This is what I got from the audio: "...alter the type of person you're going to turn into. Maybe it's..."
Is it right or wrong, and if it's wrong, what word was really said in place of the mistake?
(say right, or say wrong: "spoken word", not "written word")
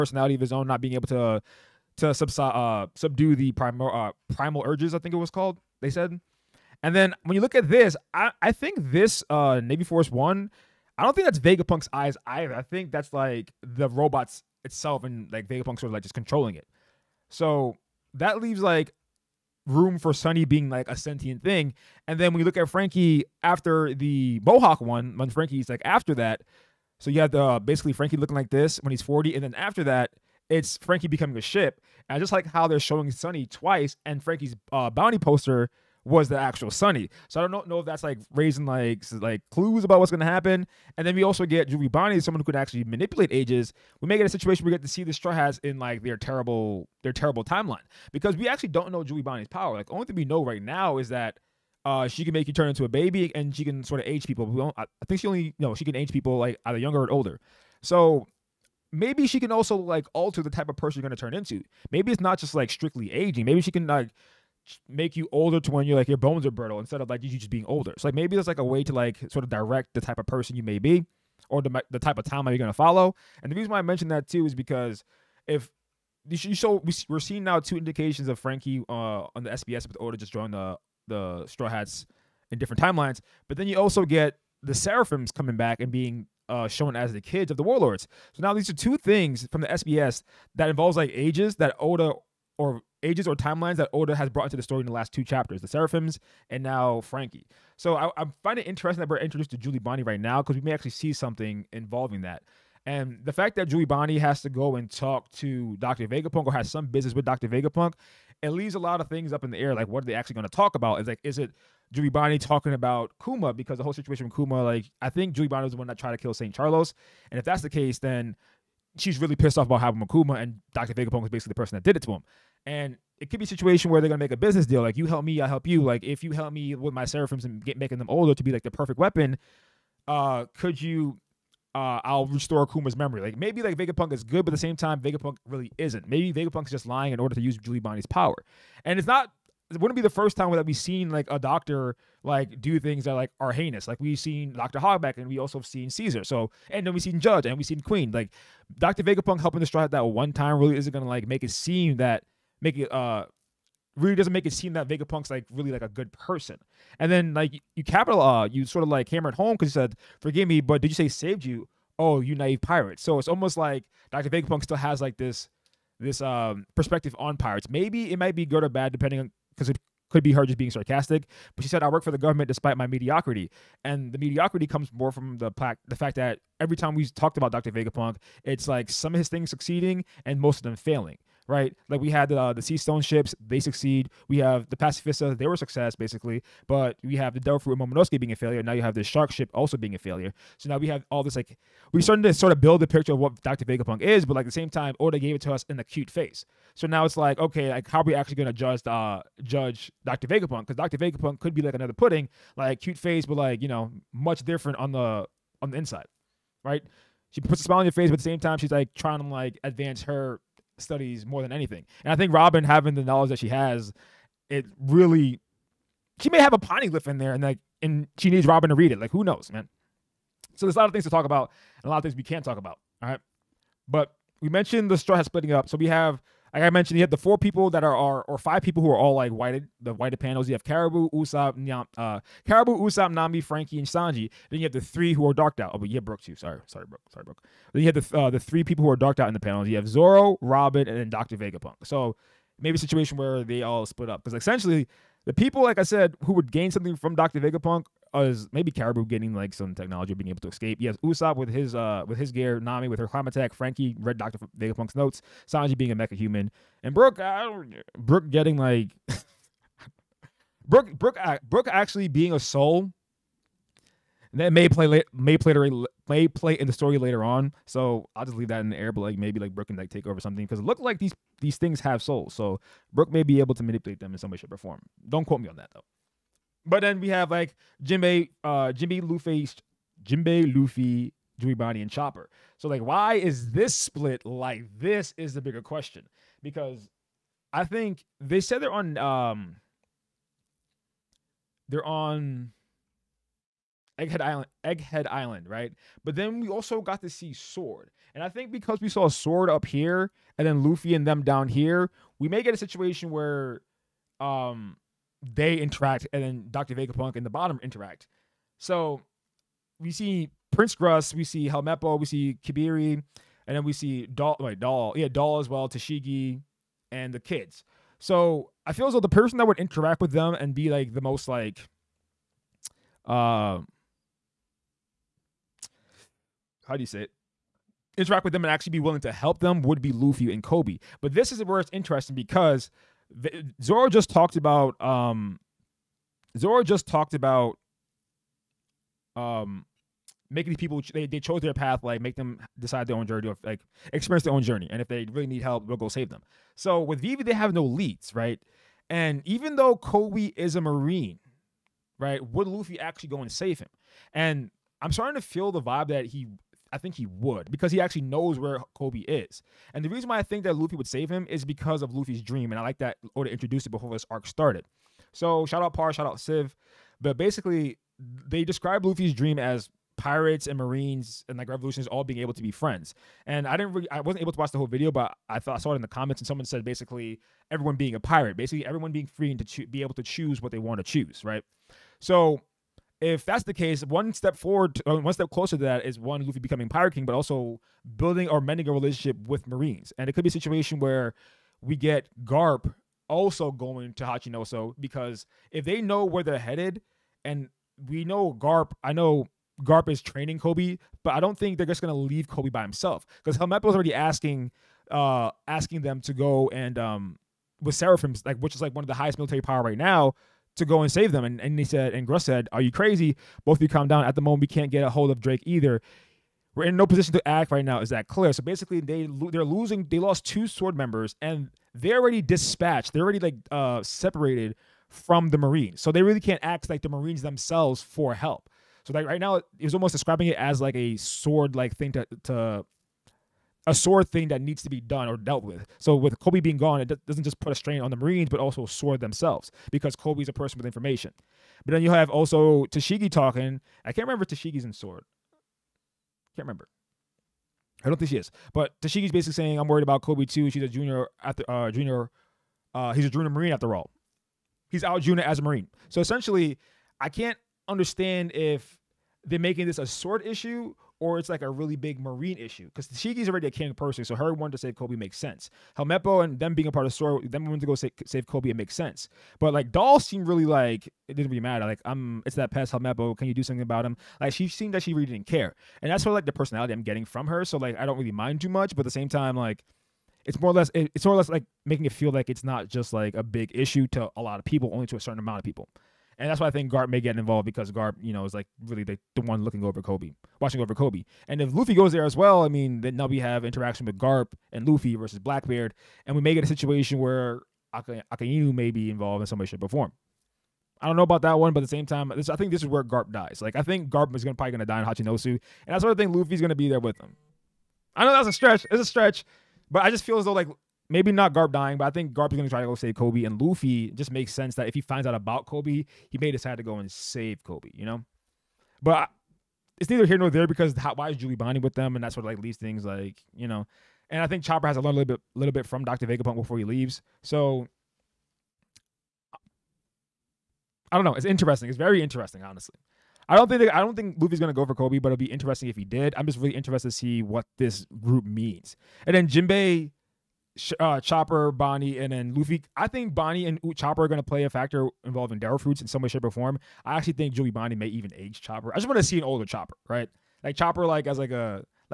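right.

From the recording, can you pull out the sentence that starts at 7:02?
They're already like uh, separated from the Marines, so they really can't act like the Marines themselves for help.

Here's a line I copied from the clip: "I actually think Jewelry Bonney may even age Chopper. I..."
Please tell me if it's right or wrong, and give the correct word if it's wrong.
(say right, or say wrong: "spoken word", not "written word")
right.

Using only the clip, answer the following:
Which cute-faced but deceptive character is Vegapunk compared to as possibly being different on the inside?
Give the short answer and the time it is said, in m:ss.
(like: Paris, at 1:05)
Pudding, at 3:21.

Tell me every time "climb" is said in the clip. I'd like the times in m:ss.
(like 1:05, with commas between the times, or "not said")
4:13.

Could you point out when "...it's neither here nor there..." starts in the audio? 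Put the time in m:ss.
8:39.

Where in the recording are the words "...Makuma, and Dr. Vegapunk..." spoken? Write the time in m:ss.
1:59.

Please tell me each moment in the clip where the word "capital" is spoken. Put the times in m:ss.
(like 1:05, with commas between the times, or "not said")
2:37.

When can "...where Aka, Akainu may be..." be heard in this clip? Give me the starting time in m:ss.
8:16.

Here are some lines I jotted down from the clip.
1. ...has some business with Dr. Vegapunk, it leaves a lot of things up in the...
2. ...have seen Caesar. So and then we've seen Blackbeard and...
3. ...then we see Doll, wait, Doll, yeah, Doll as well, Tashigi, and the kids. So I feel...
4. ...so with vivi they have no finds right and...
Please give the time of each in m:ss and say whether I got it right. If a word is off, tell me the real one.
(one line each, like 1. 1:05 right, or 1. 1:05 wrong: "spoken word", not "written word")
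1. 1:46 right
2. 2:25 wrong: "Judge", not "Blackbeard"
3. 5:13 right
4. 5:46 wrong: "leads", not "finds".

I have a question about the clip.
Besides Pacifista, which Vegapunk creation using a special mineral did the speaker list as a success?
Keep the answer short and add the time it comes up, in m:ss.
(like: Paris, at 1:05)
Sea Stone ships, at 3:02.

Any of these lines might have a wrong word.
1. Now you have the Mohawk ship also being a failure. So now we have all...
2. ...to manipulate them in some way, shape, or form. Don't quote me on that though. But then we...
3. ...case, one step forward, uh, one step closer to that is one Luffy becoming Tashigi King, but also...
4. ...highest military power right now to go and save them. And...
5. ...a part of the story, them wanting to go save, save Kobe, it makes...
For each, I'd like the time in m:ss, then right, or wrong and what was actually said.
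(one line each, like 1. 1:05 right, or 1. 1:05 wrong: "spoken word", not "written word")
1. 3:08 wrong: "Shark", not "Mohawk"
2. 4:33 right
3. 6:23 wrong: "Pirate", not "Tashigi"
4. 6:48 right
5. 7:46 right.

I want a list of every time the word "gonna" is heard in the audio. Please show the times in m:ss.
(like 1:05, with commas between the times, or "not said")
2:04, 2:30, 3:18, 6:41, 8:24, 8:32, 8:54.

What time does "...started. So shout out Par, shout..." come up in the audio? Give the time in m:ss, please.
6:04.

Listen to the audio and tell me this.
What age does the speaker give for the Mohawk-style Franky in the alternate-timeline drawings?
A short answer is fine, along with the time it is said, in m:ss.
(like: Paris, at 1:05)
40, at 0:29.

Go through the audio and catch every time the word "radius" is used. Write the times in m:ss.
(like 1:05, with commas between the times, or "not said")
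not said.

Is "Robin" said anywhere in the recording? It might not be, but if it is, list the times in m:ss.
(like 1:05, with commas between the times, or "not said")
3:32, 3:38, 4:00.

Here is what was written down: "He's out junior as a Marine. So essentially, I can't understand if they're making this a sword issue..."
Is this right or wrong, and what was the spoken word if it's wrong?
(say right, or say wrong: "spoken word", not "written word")
right.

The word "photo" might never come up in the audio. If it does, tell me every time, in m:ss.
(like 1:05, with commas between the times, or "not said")
not said.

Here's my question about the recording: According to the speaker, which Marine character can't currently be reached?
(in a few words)
Drake.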